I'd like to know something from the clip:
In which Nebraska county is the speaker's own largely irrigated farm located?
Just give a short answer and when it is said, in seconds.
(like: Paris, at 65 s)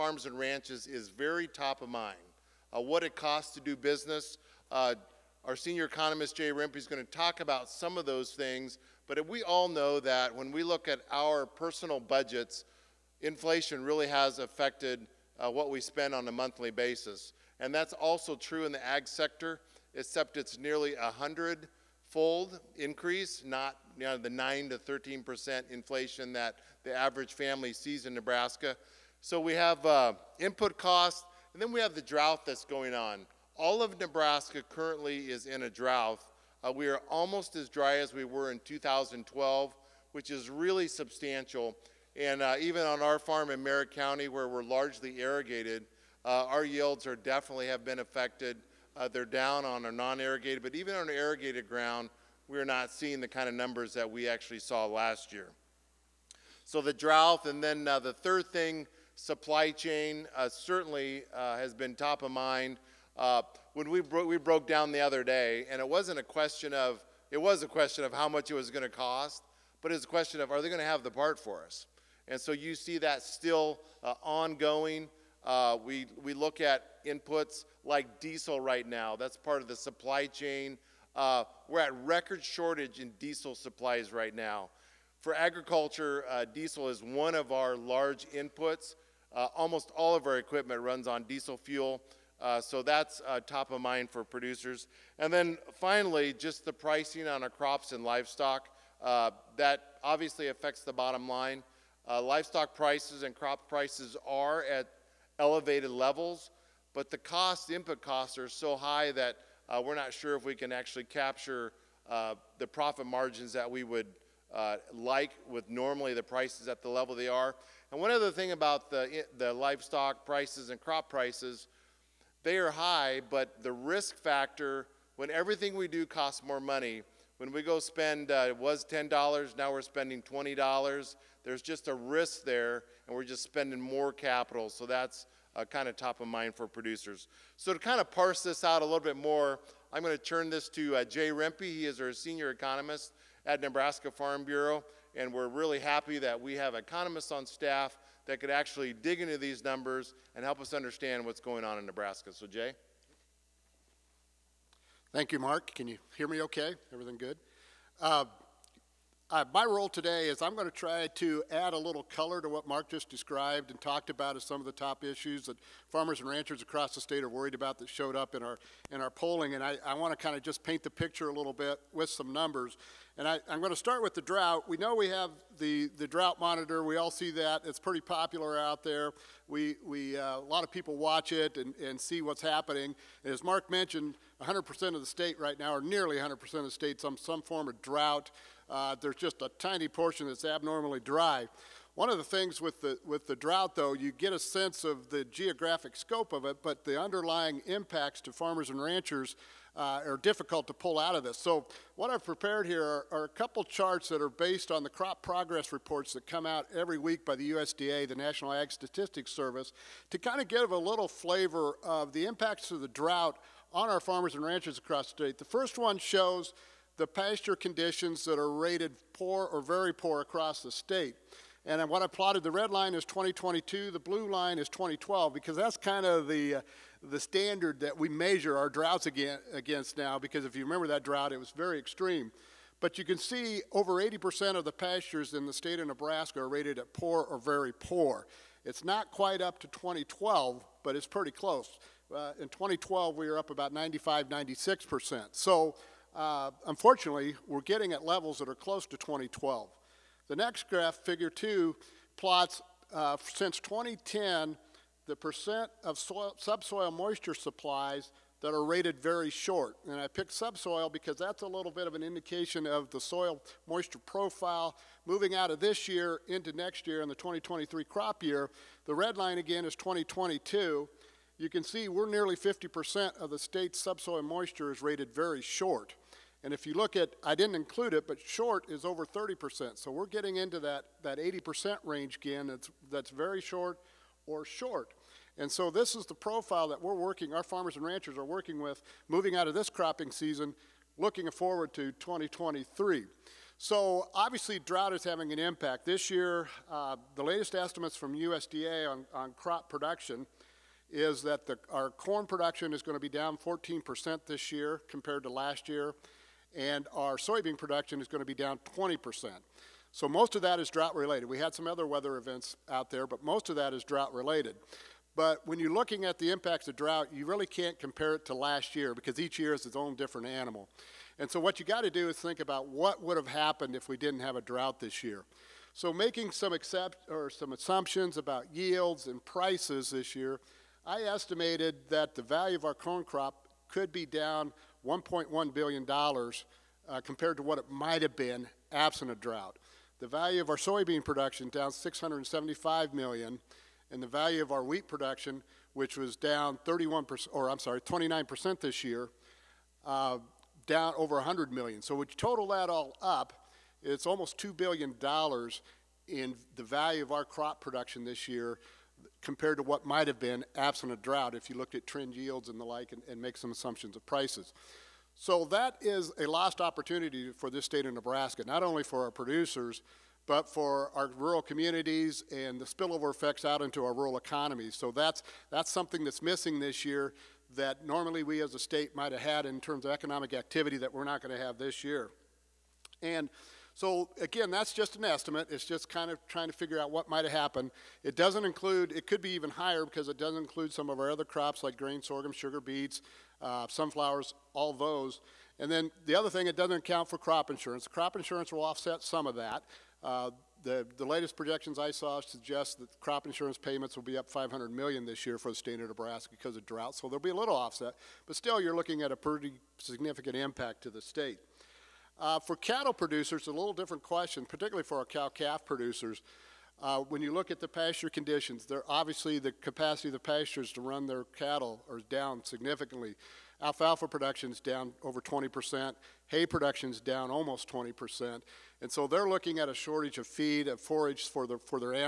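Merrick County, at 43 s.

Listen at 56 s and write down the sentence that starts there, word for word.
So the drought, and then uh, the third thing, supply chain, uh, certainly uh, has been top of mind.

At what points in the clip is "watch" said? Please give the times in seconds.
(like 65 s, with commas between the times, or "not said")
180 s.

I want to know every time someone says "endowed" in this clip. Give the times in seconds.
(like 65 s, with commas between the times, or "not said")
not said.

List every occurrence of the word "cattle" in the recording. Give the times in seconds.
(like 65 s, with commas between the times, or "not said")
412 s, 421 s.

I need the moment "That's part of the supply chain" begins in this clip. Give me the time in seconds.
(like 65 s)
79 s.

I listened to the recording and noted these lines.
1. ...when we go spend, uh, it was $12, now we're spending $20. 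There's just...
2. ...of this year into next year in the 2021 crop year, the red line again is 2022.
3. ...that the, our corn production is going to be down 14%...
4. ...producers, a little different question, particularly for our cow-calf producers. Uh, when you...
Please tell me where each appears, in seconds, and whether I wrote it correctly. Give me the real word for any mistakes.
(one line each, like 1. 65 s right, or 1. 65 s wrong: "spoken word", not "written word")
1. 127 s wrong: "10", not "12"
2. 265 s wrong: "2023", not "2021"
3. 301 s right
4. 412 s right.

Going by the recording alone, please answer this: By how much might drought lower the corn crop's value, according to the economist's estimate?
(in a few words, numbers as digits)
$1.1 billion.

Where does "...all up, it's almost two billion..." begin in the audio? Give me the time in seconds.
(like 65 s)
352 s.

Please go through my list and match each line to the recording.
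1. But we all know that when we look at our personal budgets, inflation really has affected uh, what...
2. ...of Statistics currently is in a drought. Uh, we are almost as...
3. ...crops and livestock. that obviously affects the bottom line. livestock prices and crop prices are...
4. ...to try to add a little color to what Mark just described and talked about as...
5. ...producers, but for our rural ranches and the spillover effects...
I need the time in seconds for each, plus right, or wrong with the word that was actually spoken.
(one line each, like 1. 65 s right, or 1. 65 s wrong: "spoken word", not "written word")
1. 9 s right
2. 33 s wrong: "Nebraska", not "Statistics"
3. 97 s right
4. 160 s right
5. 369 s wrong: "communities", not "ranches".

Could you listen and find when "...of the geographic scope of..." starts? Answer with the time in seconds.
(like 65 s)
194 s.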